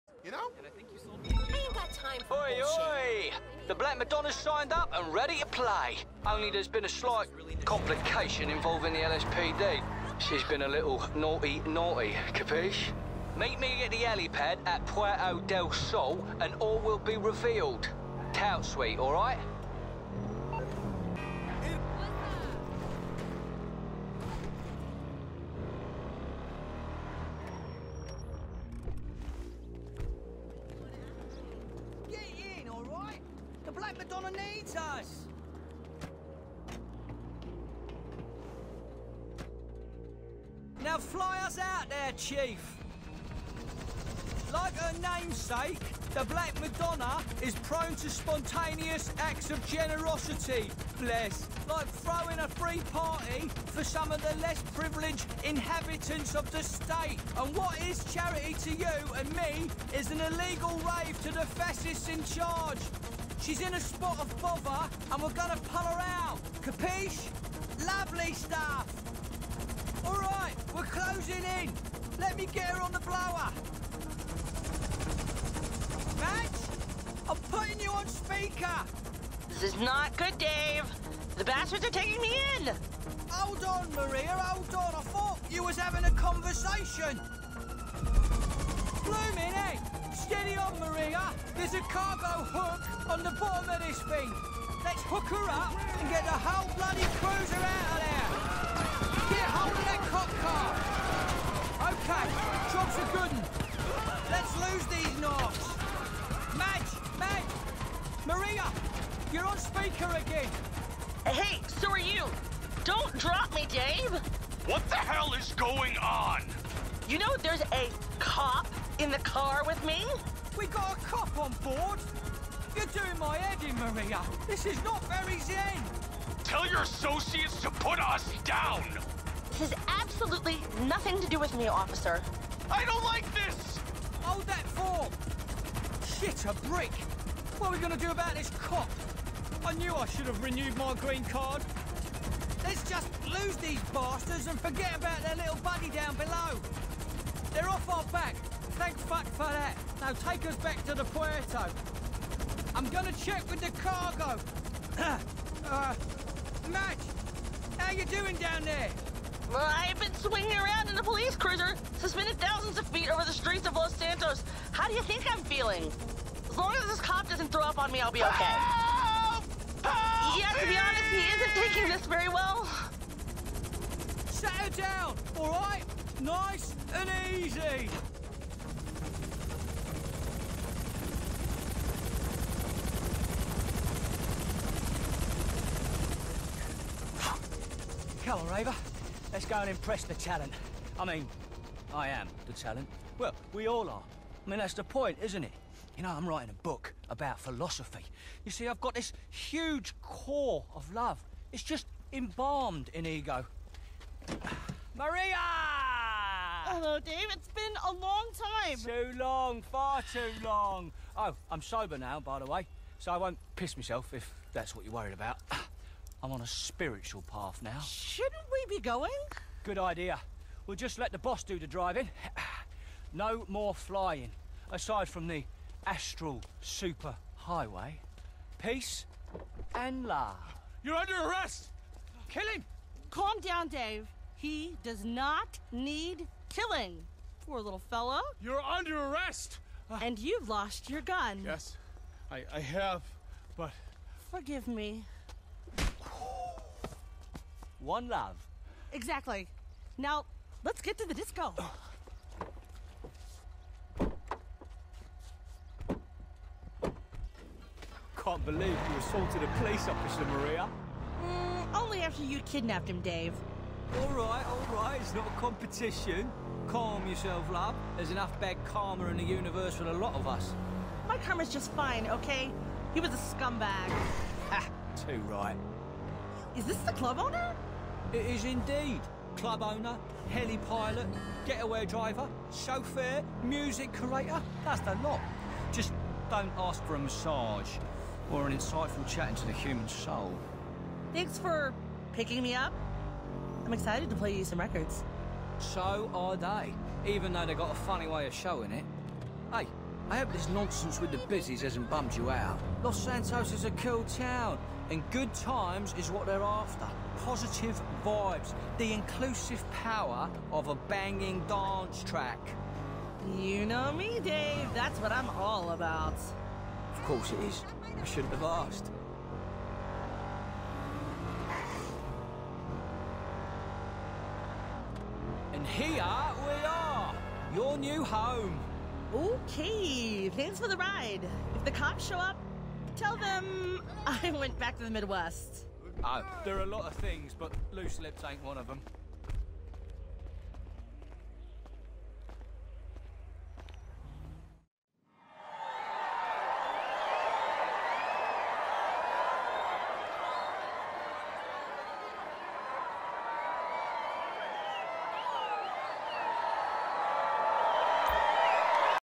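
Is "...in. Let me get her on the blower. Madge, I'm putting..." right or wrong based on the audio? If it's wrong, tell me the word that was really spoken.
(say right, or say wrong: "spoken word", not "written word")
right.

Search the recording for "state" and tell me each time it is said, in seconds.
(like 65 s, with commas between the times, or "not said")
56 s.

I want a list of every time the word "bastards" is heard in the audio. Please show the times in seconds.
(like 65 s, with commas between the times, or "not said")
81 s, 143 s.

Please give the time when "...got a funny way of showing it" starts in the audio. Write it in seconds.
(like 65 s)
297 s.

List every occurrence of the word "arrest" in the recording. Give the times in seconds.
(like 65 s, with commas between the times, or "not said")
231 s, 238 s.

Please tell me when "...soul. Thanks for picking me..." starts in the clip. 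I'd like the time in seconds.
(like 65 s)
289 s.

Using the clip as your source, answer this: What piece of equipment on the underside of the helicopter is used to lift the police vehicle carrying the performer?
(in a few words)
cargo hook.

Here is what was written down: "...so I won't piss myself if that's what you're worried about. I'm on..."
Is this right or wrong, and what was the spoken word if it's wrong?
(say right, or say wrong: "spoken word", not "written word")
right.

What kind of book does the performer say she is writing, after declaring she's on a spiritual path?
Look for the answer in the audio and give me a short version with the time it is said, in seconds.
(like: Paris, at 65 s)
philosophy, at 197 s.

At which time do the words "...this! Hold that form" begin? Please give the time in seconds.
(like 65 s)
133 s.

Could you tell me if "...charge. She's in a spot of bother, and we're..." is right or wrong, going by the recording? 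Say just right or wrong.
right.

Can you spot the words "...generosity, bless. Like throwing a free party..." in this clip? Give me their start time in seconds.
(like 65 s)
49 s.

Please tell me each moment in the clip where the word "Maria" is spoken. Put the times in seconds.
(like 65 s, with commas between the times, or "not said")
83 s, 90 s, 108 s, 123 s, 204 s, 260 s.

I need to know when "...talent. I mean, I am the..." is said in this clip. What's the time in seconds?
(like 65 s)
190 s.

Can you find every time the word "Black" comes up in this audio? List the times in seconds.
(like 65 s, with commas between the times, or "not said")
3 s, 46 s.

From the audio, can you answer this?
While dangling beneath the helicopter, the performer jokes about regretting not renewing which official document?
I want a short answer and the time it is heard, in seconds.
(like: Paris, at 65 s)
green card, at 140 s.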